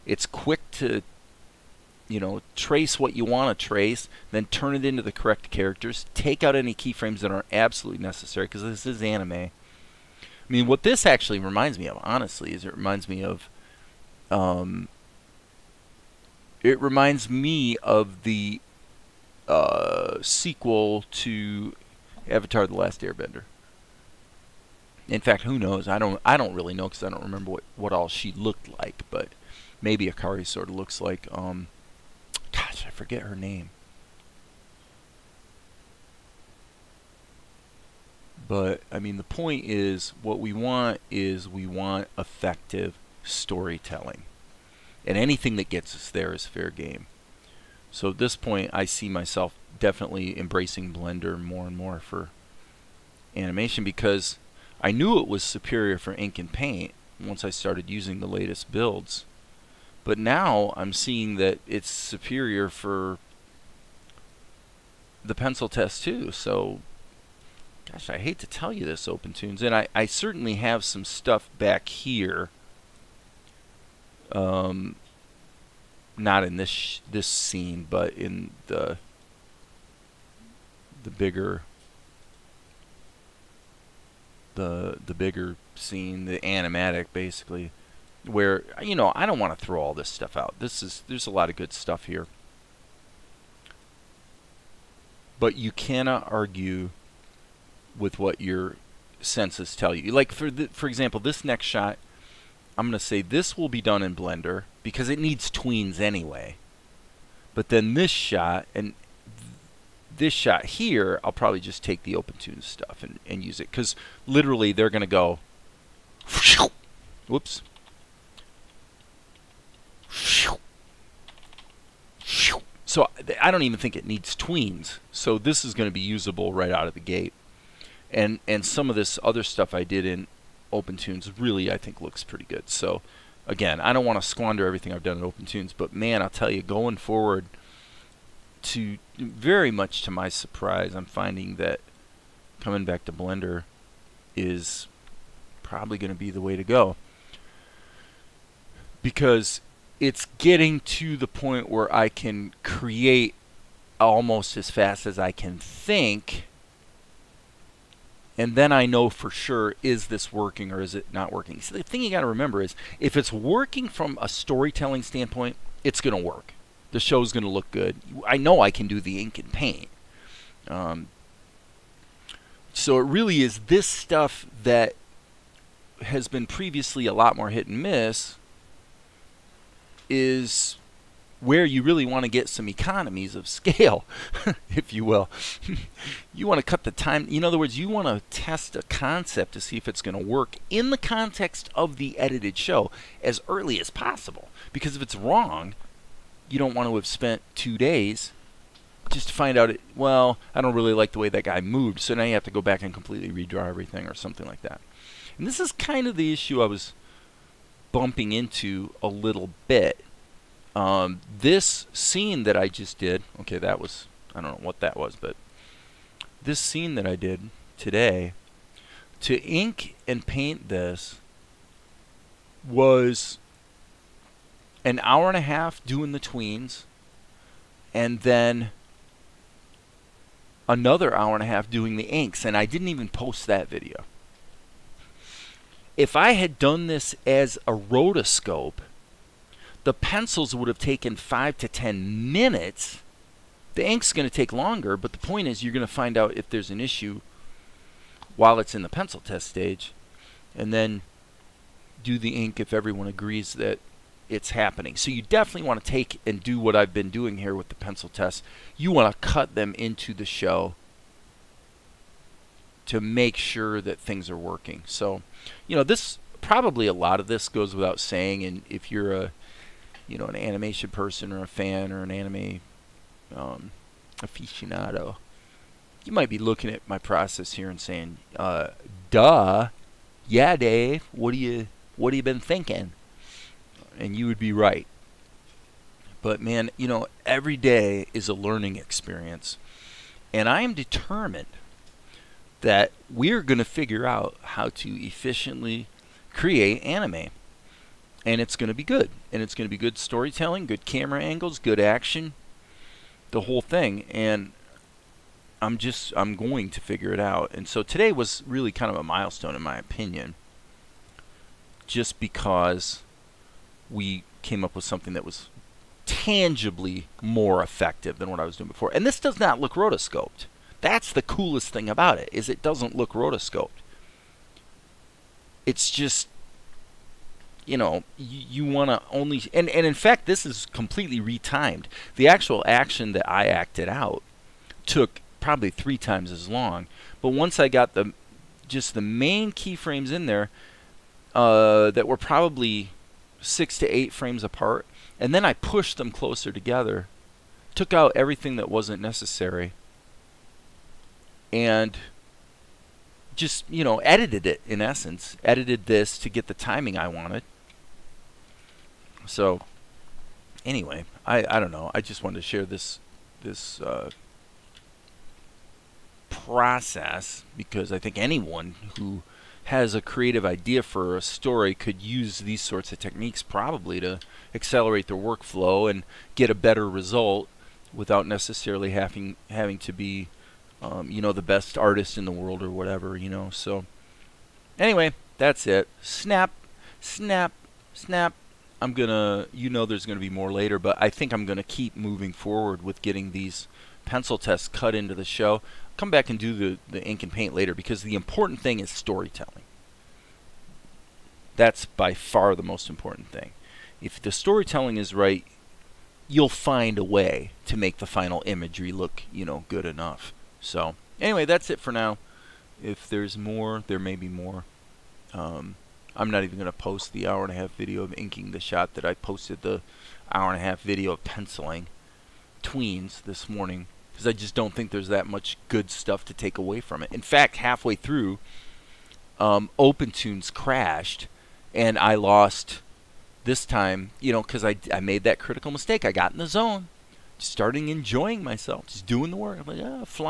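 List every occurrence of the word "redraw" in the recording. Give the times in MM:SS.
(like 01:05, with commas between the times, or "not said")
03:23.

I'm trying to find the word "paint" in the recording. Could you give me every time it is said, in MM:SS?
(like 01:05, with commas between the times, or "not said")
00:56, 02:49, 03:40, 06:37.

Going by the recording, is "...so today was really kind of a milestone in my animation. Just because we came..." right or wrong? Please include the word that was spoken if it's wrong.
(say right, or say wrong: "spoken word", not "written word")
wrong: "opinion", not "animation".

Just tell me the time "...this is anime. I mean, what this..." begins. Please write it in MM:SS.
00:08.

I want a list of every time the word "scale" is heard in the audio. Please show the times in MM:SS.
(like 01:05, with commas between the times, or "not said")
03:03.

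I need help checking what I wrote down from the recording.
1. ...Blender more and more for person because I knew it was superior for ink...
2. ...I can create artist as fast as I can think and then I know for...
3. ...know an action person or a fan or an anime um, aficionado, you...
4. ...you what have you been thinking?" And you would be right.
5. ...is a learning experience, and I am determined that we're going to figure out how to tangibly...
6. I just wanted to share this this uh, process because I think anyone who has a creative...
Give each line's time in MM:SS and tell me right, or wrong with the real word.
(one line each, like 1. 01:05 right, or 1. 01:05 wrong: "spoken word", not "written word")
1. 00:50 wrong: "animation", not "person"
2. 02:31 wrong: "almost", not "artist"
3. 04:30 wrong: "animation", not "action"
4. 04:41 right
5. 04:48 wrong: "efficiently", not "tangibly"
6. 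06:01 right.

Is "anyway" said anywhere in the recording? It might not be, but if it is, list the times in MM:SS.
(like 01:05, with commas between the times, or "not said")
01:45, 06:00, 06:24, 06:51.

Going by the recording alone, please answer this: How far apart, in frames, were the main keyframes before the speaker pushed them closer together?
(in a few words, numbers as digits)
6 to 8 frames.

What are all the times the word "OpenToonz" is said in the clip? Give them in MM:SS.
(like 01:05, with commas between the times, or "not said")
01:09, 01:52, 02:10, 02:15, 07:09.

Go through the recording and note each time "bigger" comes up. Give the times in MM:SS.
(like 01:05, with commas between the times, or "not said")
01:21, 01:25.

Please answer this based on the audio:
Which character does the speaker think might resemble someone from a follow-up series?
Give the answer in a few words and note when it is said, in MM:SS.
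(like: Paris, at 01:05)
Akari, at 00:30.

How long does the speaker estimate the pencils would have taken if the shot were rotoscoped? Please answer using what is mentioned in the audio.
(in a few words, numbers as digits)
5 to 10 minutes.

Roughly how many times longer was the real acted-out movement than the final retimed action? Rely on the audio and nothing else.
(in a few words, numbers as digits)
3 times.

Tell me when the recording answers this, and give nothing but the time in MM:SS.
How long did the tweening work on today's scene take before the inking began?
03:44.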